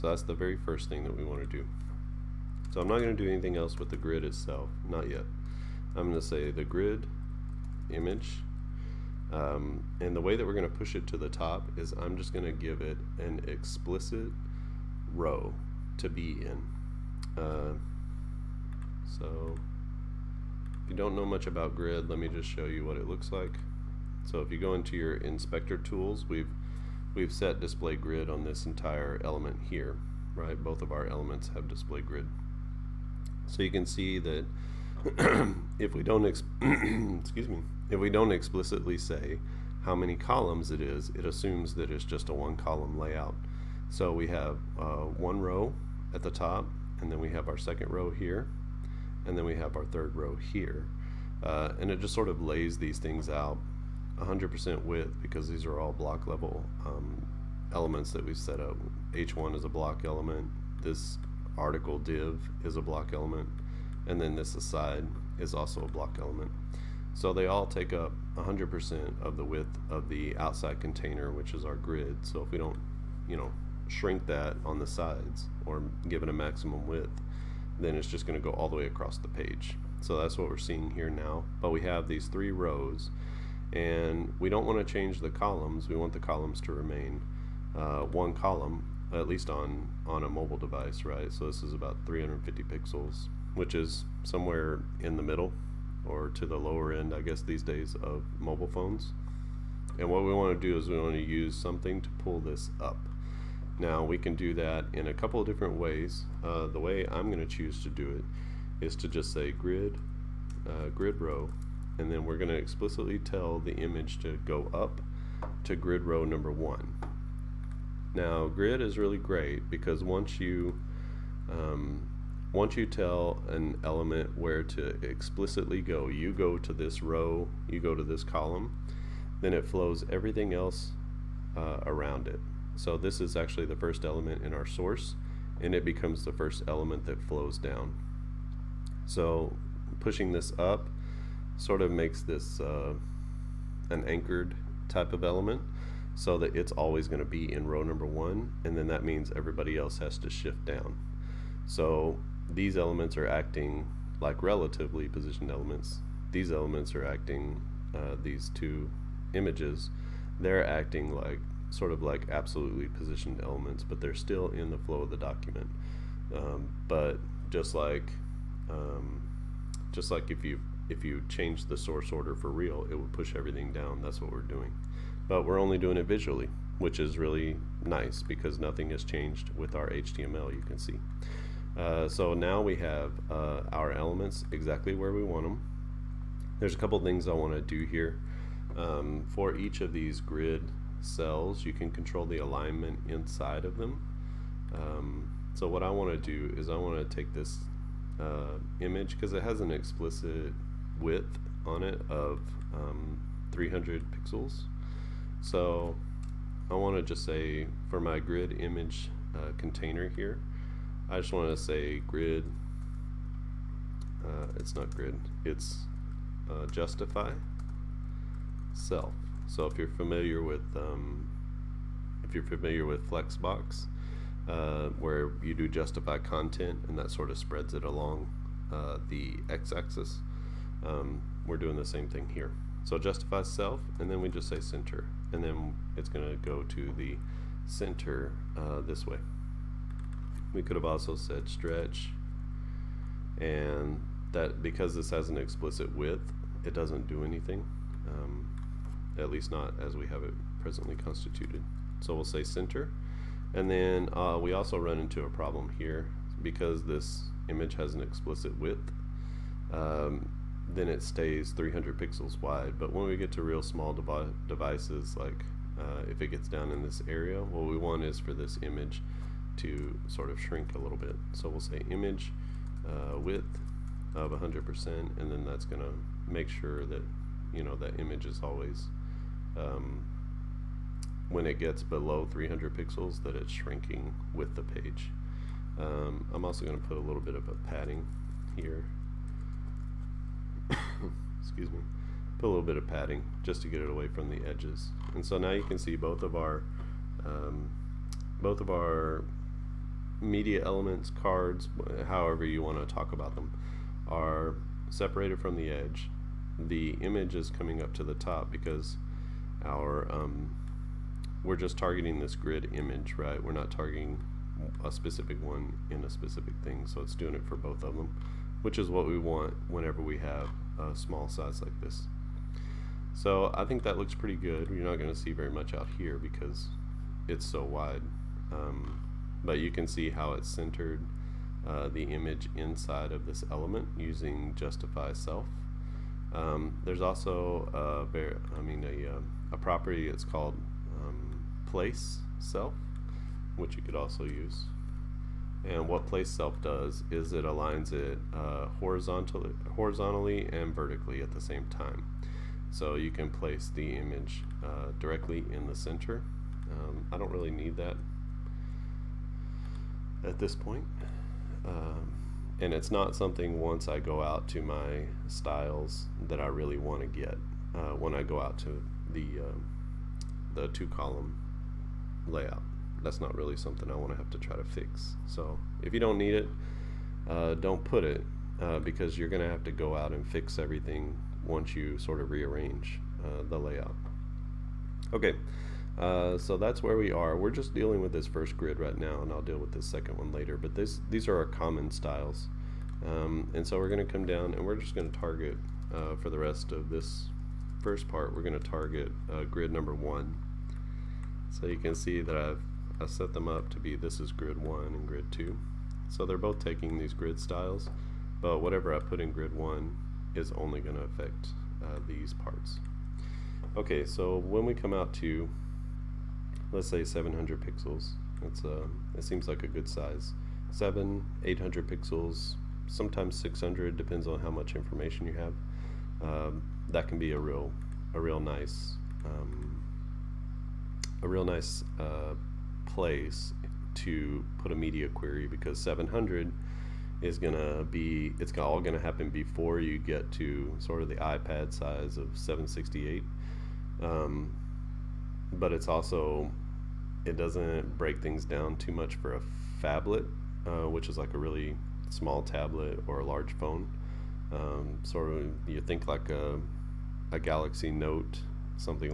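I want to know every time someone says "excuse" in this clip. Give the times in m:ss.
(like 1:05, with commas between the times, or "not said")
0:36, 4:51.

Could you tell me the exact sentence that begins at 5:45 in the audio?
And what place self does is it aligns it uh, horizontally, horizontally and vertically at the same time.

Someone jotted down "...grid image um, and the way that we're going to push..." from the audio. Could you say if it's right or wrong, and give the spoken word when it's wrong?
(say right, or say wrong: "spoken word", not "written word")
right.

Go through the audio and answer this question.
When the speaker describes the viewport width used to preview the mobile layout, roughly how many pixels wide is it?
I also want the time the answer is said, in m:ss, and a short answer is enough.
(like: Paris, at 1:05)
350 pixels, at 1:32.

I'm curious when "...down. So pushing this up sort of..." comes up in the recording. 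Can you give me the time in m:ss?
2:17.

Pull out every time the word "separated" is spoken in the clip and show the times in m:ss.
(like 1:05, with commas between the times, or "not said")
5:04.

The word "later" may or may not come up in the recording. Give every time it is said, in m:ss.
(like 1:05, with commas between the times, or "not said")
6:30.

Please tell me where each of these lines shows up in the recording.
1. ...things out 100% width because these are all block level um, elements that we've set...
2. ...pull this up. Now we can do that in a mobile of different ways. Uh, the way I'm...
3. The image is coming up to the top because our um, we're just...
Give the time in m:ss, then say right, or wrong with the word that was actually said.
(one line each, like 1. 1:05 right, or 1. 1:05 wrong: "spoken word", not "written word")
1. 0:52 right
2. 1:42 wrong: "couple", not "mobile"
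3. 5:06 right.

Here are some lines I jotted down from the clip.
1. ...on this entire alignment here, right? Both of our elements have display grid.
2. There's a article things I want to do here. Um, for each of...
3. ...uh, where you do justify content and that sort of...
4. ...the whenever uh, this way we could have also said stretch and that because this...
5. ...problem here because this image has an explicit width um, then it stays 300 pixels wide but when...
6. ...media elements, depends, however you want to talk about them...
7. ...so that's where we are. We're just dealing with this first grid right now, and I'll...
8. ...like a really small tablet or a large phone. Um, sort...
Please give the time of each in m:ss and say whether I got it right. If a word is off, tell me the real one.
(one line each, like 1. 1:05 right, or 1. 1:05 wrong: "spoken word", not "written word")
1. 0:28 wrong: "element", not "alignment"
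2. 3:06 wrong: "couple", not "article"
3. 3:44 right
4. 3:56 wrong: "center", not "whenever"
5. 4:15 right
6. 5:00 wrong: "cards", not "depends"
7. 6:26 right
8. 7:31 right.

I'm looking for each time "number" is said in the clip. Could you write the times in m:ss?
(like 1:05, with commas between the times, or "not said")
1:56, 2:27, 6:39.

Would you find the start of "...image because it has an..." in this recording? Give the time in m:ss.
3:18.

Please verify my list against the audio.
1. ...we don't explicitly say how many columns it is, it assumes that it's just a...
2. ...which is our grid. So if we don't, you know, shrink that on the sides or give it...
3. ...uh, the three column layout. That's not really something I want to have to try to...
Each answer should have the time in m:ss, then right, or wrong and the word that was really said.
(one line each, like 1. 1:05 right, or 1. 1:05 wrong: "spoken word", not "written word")
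1. 0:38 right
2. 1:11 right
3. 6:09 wrong: "two", not "three".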